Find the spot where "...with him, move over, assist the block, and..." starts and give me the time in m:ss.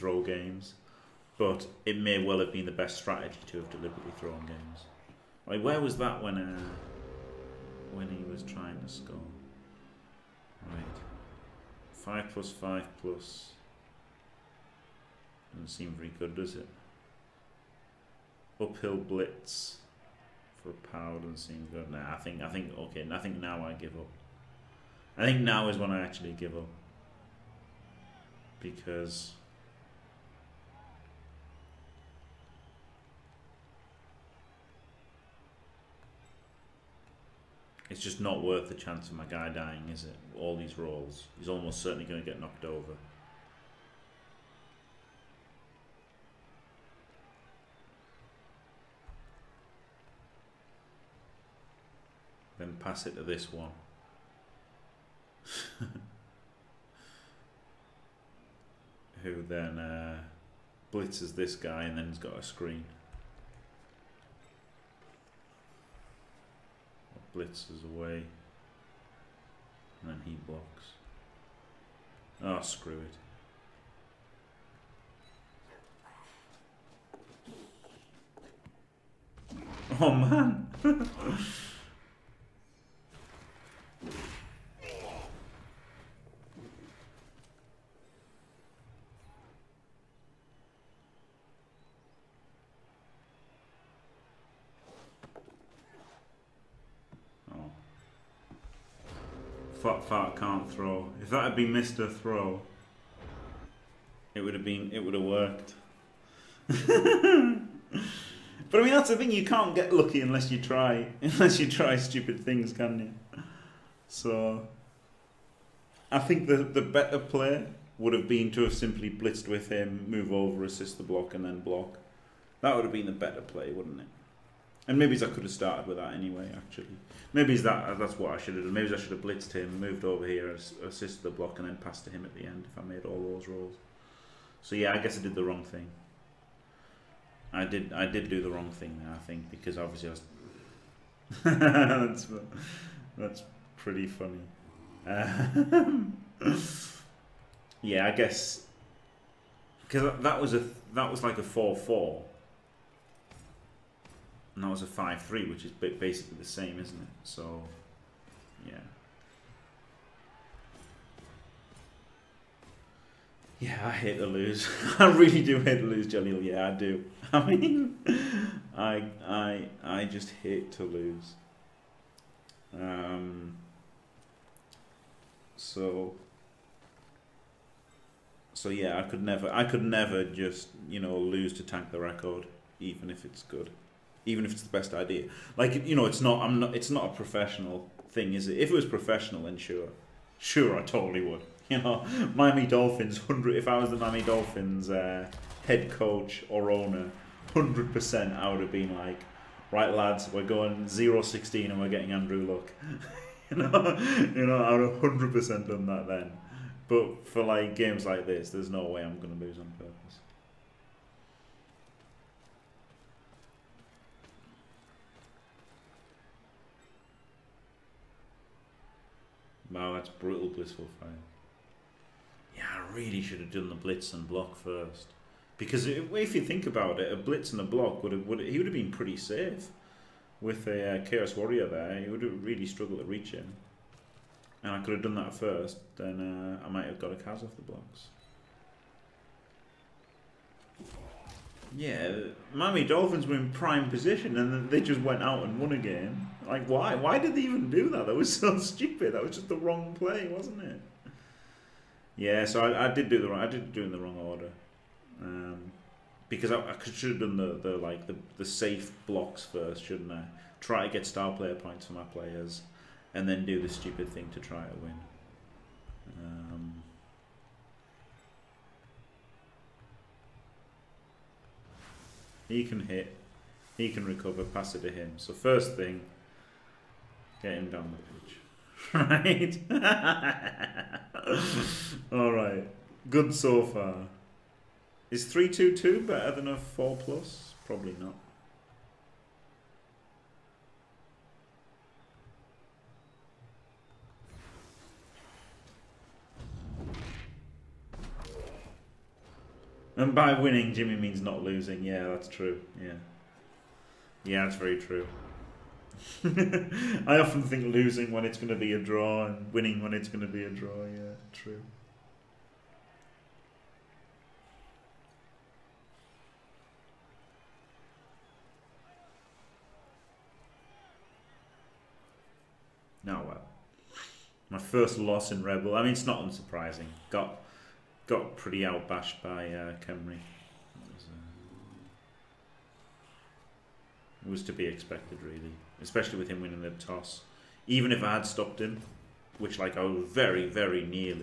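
1:59.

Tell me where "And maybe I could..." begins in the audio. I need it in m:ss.
2:04.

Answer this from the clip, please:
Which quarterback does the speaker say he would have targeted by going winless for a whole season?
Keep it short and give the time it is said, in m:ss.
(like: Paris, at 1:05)
Andrew Luck, at 3:22.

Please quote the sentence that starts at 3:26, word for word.
But for like games like this, there's no way I'm gonna lose on purpose.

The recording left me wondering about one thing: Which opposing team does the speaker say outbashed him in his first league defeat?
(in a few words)
Khemri.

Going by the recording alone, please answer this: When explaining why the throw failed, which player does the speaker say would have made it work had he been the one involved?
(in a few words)
Mr. Throw.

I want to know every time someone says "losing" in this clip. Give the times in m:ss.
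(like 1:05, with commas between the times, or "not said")
5:01, 5:07.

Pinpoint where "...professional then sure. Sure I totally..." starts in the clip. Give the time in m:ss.
3:08.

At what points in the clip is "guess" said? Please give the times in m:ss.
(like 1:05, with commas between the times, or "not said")
2:14, 2:28.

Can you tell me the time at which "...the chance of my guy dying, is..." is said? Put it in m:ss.
0:38.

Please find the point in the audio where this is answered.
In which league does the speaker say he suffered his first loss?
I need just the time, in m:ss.
5:25.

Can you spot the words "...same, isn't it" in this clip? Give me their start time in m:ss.
2:36.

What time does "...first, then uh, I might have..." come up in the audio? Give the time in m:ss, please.
3:55.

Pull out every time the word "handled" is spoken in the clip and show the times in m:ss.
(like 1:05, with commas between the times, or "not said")
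not said.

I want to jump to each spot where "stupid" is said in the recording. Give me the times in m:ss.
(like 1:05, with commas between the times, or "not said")
1:51, 4:08, 4:23.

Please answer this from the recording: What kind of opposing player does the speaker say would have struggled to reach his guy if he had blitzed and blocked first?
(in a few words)
Chaos Warrior.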